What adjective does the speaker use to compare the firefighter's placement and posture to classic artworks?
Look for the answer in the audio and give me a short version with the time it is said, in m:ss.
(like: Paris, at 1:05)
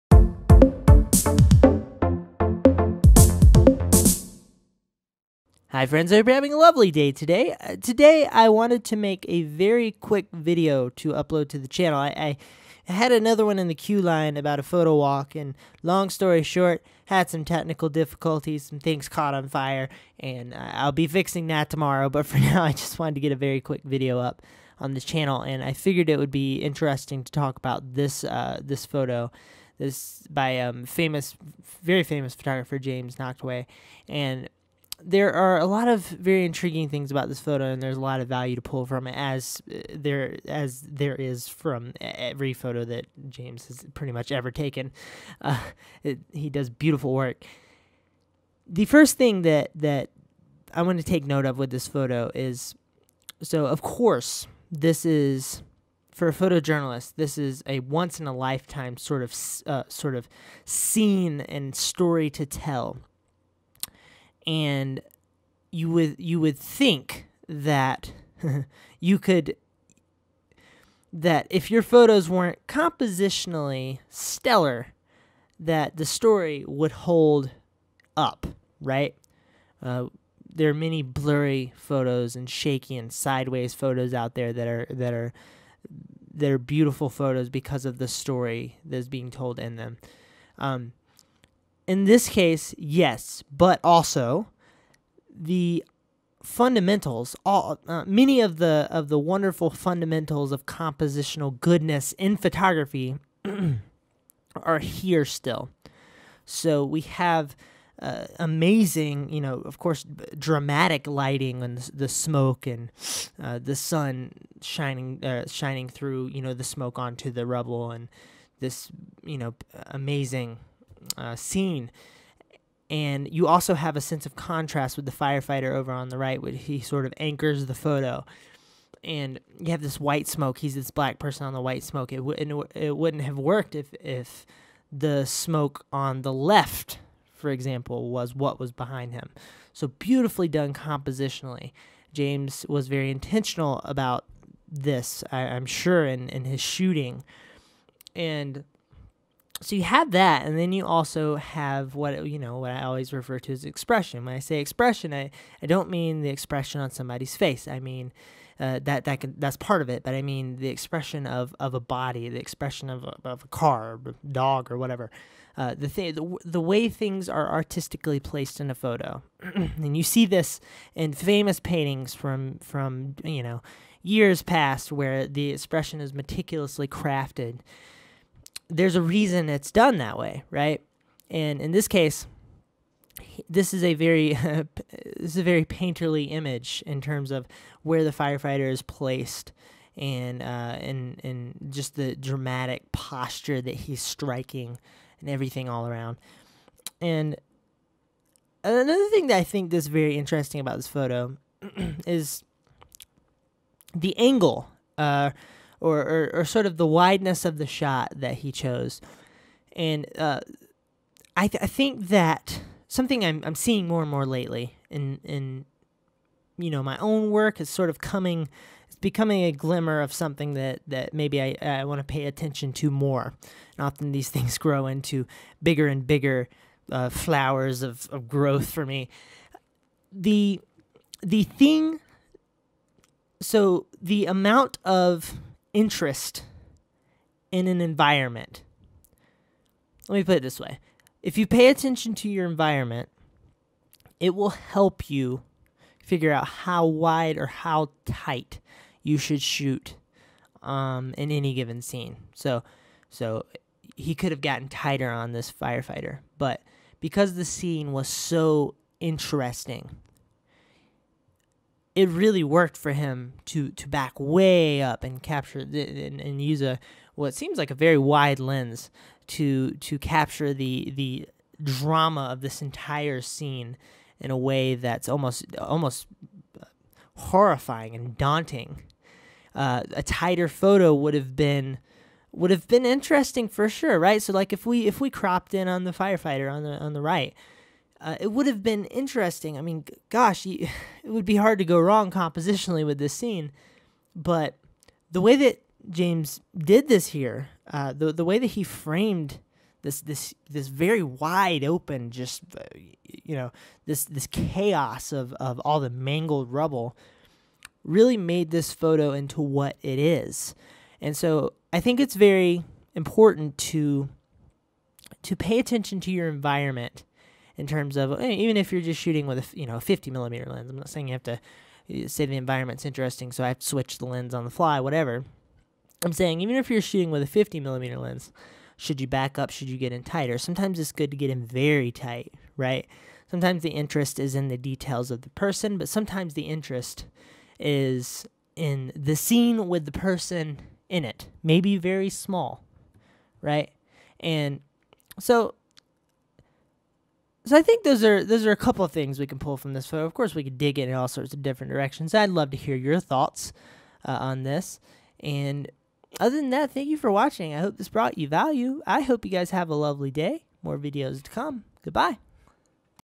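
painterly, at 3:05.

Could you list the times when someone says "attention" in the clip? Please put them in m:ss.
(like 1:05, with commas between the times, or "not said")
3:42, 4:01, 5:15.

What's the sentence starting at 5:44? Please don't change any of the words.
And so so I think those are those are a couple of things we can pull from this photo.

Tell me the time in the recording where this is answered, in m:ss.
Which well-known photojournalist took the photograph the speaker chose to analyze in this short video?
0:32.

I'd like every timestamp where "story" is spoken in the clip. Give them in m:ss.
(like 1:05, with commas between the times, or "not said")
0:16, 1:01, 1:16, 1:28.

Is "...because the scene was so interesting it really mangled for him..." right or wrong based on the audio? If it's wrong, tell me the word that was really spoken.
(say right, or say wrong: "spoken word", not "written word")
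wrong: "worked", not "mangled".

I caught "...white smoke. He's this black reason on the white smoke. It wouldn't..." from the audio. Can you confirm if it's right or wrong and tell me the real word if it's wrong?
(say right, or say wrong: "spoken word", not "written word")
wrong: "person", not "reason".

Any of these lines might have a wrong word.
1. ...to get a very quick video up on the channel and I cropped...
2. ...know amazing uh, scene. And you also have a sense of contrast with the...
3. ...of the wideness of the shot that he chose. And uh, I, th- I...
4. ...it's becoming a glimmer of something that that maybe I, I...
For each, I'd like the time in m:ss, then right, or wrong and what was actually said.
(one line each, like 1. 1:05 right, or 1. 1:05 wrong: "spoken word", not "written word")
1. 0:23 wrong: "figured", not "cropped"
2. 1:59 right
3. 3:26 right
4. 3:38 right.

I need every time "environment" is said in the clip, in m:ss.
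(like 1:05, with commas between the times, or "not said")
3:57, 4:02, 5:16, 5:22.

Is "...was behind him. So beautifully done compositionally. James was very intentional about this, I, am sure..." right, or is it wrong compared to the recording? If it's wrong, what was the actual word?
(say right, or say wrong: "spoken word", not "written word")
right.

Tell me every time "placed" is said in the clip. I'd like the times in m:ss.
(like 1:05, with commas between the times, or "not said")
2:48, 3:08.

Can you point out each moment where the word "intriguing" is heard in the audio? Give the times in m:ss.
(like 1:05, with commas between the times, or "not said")
0:36.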